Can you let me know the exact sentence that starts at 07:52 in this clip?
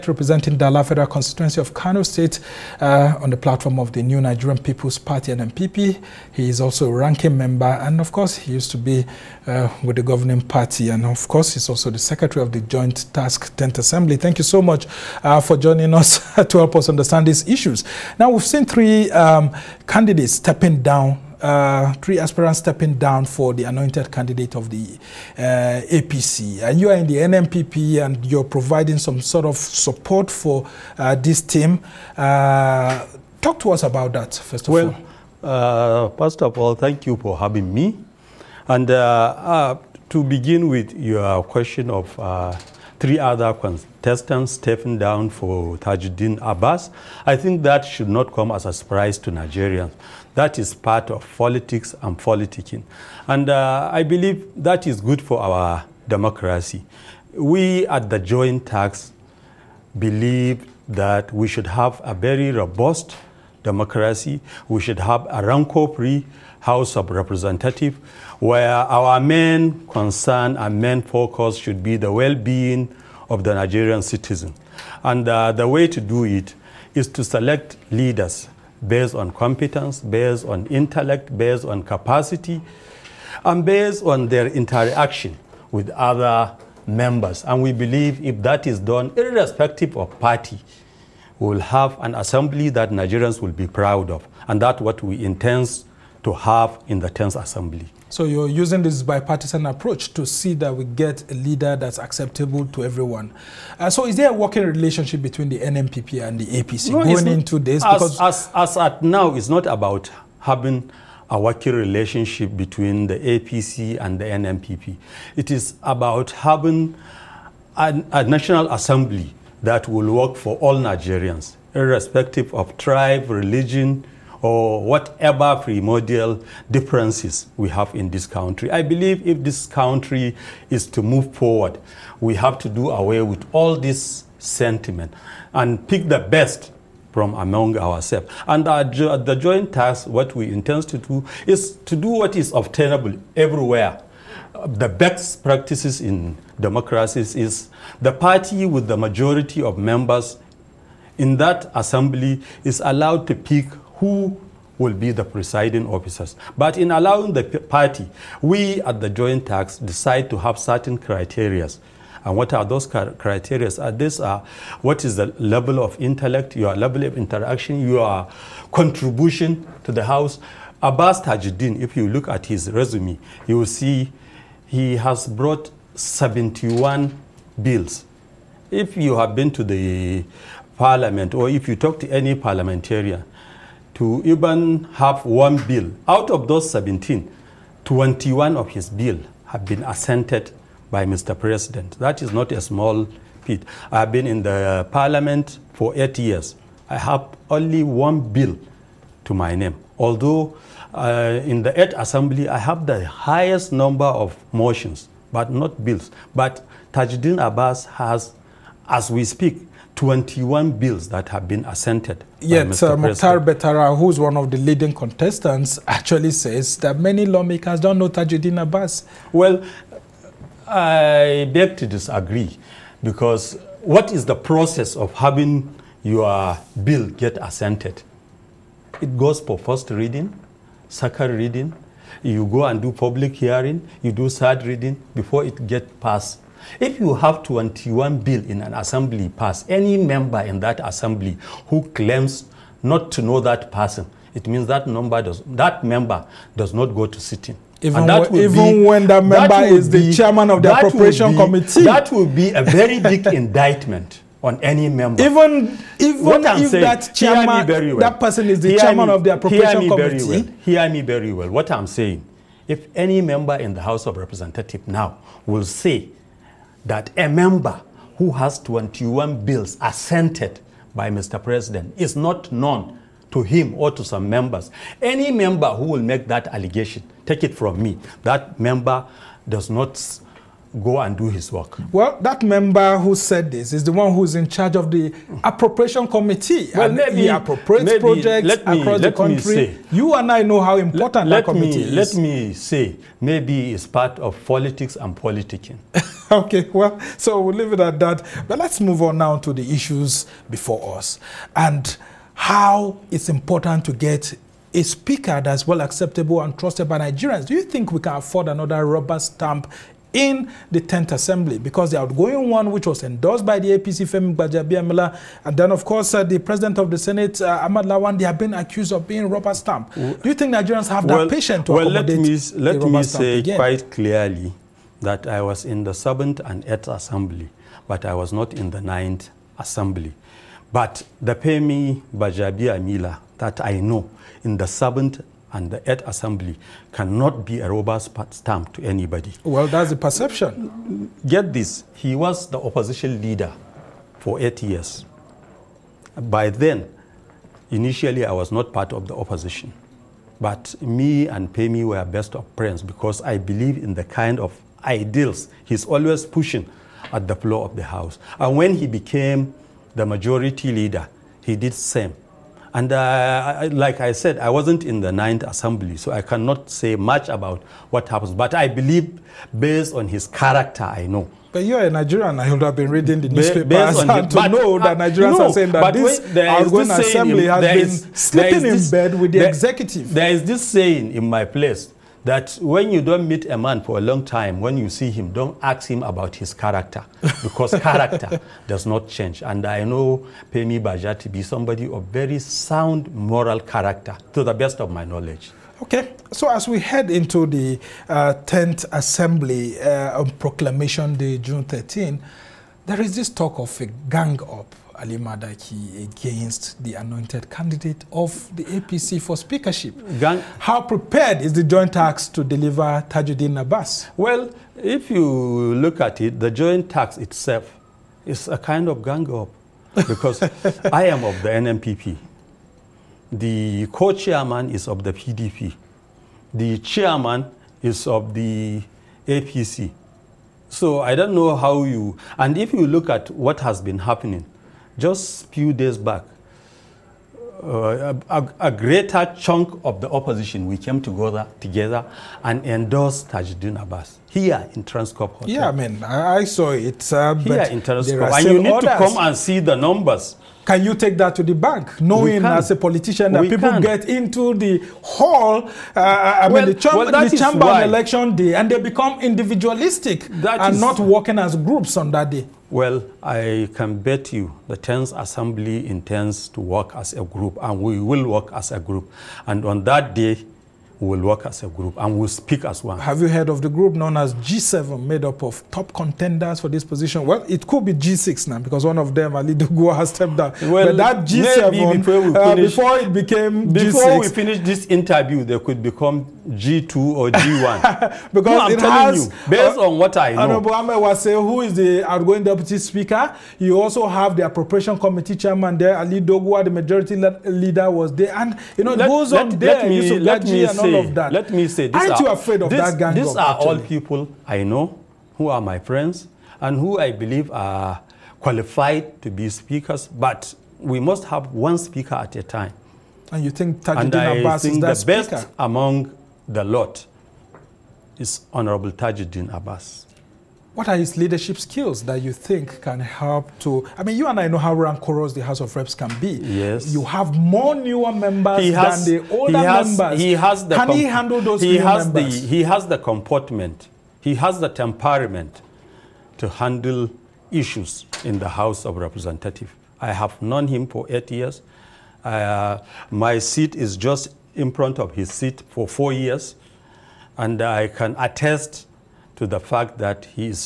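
Have you heard of the group known as G7, made up of top contenders for this position?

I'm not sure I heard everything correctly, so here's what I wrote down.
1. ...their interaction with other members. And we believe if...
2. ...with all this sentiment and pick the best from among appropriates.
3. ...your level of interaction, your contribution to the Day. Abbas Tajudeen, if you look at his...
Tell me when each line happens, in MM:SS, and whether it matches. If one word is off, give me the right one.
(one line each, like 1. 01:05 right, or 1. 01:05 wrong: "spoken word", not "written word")
1. 01:24 right
2. 02:13 wrong: "ourselves", not "appropriates"
3. 02:46 wrong: "House", not "Day".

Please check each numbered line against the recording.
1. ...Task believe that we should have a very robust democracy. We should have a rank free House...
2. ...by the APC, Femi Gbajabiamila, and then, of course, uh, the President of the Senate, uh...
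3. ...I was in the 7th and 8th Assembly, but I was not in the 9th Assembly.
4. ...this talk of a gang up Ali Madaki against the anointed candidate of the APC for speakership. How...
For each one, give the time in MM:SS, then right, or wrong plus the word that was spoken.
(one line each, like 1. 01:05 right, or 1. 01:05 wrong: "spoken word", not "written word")
1. 00:58 right
2. 05:13 right
3. 05:25 right
4. 06:43 right.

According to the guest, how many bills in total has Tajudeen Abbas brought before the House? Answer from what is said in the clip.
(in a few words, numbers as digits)
71.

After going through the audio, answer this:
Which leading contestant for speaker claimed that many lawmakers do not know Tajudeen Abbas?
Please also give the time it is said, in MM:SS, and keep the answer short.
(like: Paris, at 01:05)
Mukhtar Betara, at 03:32.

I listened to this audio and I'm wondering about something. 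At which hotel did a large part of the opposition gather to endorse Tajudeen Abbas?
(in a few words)
Transcorp Hotel.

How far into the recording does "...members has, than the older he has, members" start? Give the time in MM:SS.
08:48.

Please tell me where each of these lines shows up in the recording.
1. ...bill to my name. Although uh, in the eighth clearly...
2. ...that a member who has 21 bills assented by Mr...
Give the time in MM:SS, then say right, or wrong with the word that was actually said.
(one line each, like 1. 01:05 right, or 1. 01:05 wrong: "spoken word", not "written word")
1. 03:18 wrong: "assembly", not "clearly"
2. 04:26 right.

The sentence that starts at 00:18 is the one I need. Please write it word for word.
Now, we've seen three um, candidates stepping down uh, three aspirants stepping down for the anointed candidate of the uh, APC.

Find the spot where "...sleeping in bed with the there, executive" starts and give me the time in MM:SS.
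06:18.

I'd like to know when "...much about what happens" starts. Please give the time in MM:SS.
06:06.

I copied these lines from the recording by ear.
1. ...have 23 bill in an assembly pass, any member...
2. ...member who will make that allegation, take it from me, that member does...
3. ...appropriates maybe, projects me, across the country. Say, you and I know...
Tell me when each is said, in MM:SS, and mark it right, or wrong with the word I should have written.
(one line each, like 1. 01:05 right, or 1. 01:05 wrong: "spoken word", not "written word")
1. 03:57 wrong: "21", not "23"
2. 04:35 right
3. 04:47 right.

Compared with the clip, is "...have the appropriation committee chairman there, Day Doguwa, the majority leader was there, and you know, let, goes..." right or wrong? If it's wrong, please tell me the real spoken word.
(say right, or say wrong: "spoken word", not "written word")
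wrong: "Ali", not "Day".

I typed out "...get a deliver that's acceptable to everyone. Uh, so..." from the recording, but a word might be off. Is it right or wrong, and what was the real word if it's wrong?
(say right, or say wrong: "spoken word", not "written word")
wrong: "leader", not "deliver".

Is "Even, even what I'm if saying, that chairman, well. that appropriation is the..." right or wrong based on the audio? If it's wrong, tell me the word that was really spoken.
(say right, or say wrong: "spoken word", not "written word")
wrong: "person", not "appropriation".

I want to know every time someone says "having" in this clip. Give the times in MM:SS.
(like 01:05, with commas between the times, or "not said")
00:37, 01:50, 01:56, 03:45.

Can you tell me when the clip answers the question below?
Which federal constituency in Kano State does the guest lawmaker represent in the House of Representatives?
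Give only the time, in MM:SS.
00:00.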